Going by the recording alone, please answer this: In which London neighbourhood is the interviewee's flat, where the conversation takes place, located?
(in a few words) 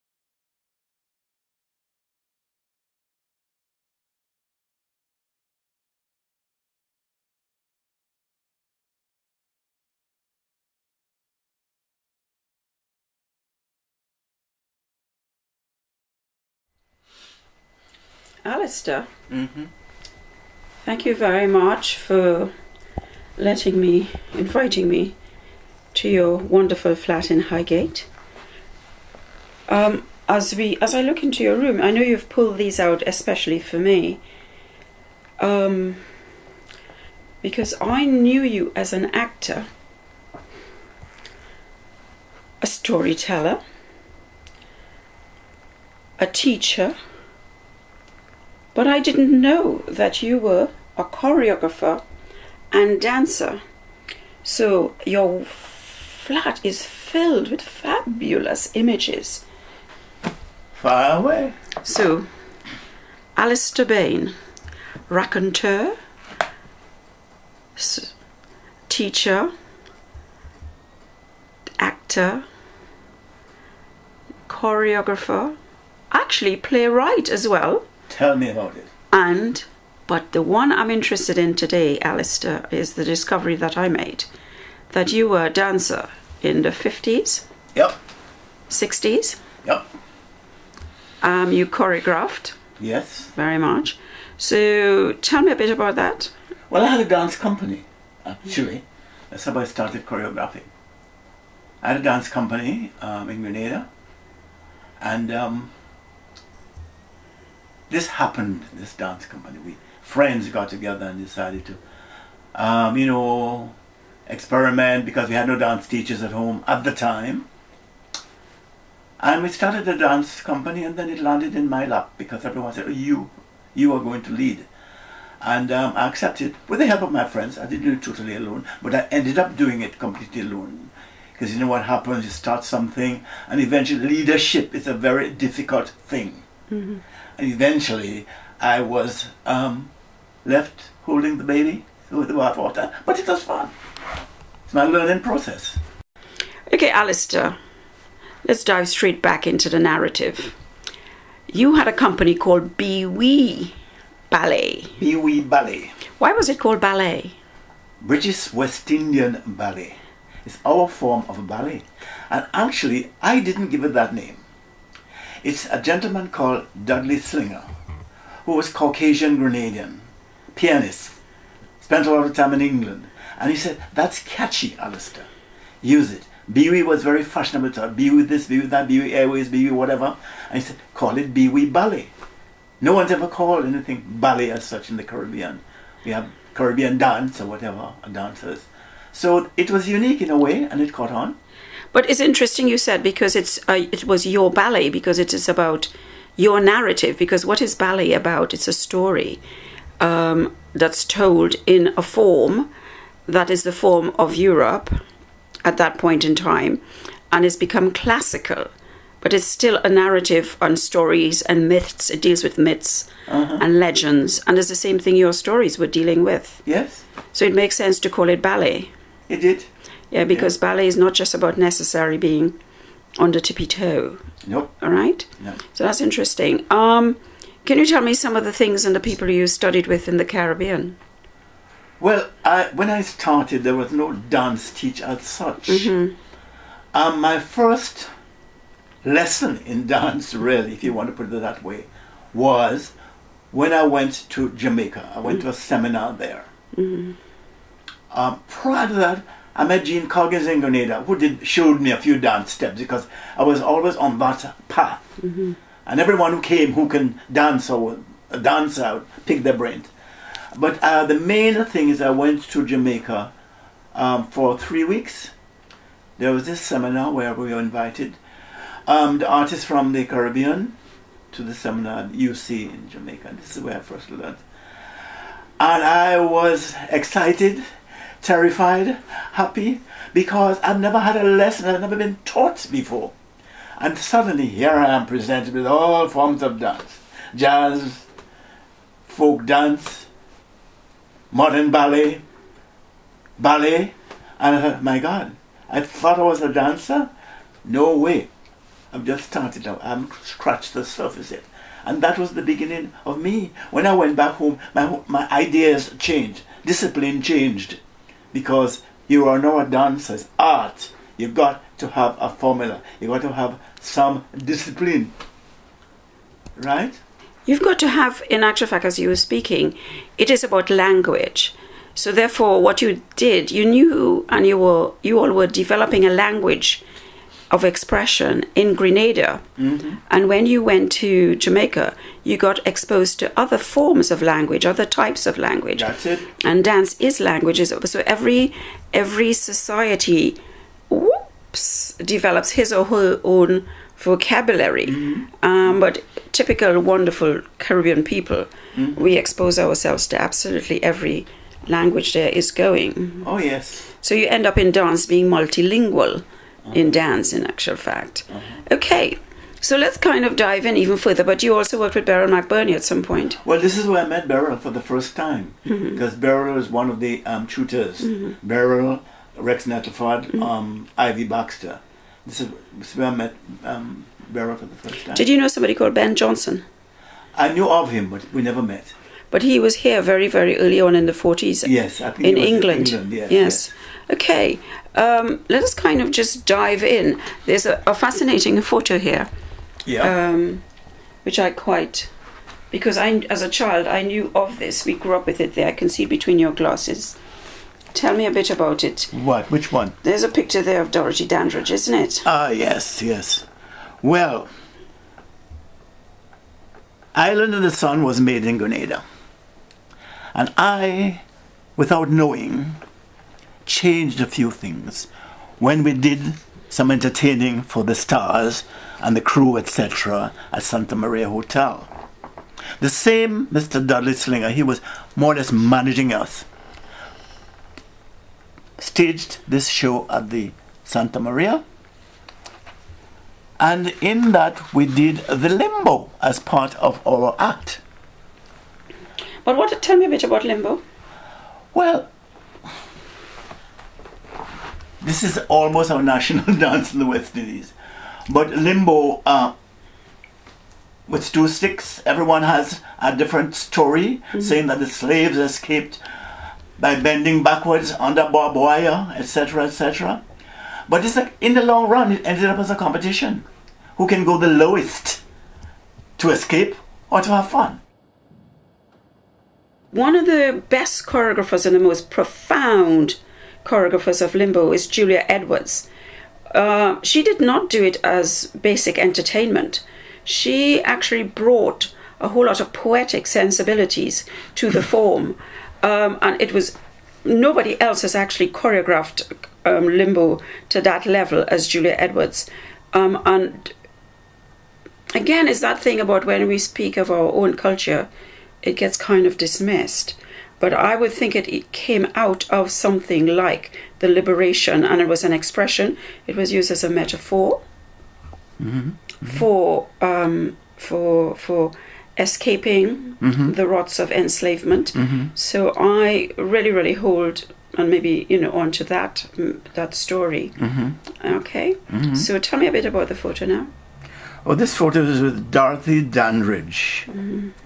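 Highgate.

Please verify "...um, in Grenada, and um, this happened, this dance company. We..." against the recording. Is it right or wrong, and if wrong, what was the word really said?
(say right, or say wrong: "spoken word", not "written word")
right.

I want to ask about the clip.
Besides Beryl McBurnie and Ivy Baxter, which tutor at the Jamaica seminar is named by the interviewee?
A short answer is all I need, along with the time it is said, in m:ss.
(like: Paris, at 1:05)
Rex Nettleford, at 6:09.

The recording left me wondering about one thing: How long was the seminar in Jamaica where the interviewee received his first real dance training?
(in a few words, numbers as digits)
3 weeks.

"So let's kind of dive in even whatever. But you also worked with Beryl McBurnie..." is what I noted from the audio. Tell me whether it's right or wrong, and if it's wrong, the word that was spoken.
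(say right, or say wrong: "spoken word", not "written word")
wrong: "further", not "whatever".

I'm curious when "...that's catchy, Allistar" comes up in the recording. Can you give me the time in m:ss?
2:53.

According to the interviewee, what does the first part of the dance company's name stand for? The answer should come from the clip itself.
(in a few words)
British West Indian.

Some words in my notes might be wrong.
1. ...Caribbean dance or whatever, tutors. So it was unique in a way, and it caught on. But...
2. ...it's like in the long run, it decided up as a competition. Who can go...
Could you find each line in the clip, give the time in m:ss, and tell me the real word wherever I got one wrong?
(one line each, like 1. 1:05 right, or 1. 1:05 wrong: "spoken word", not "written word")
1. 3:06 wrong: "dancers", not "tutors"
2. 7:41 wrong: "ended", not "decided".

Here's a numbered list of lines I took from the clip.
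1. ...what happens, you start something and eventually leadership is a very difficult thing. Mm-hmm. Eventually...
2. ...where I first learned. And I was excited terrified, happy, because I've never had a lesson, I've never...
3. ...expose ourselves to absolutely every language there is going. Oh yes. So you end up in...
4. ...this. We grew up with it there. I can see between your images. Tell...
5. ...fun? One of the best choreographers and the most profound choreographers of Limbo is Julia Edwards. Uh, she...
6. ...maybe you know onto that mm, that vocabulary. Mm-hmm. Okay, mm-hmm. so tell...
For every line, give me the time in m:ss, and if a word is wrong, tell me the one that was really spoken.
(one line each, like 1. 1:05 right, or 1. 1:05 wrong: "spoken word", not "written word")
1. 2:11 right
2. 4:33 right
3. 5:49 right
4. 6:34 wrong: "glasses", not "images"
5. 7:47 right
6. 8:37 wrong: "story", not "vocabulary".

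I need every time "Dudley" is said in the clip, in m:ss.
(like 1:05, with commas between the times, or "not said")
2:46, 7:03.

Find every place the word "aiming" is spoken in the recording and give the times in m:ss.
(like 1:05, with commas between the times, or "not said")
not said.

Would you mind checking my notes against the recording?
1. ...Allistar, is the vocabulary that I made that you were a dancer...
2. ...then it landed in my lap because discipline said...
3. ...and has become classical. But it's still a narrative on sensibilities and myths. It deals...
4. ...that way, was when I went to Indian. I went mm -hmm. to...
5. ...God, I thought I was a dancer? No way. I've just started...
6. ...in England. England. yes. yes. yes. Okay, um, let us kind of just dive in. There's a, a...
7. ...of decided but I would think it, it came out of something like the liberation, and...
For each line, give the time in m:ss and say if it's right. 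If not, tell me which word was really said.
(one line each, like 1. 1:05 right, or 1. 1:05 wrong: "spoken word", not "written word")
1. 1:22 wrong: "discovery", not "vocabulary"
2. 2:00 wrong: "everyone", not "discipline"
3. 3:27 wrong: "stories", not "sensibilities"
4. 4:01 wrong: "Jamaica", not "Indian"
5. 4:54 right
6. 6:22 right
7. 8:19 wrong: "dismissed", not "decided".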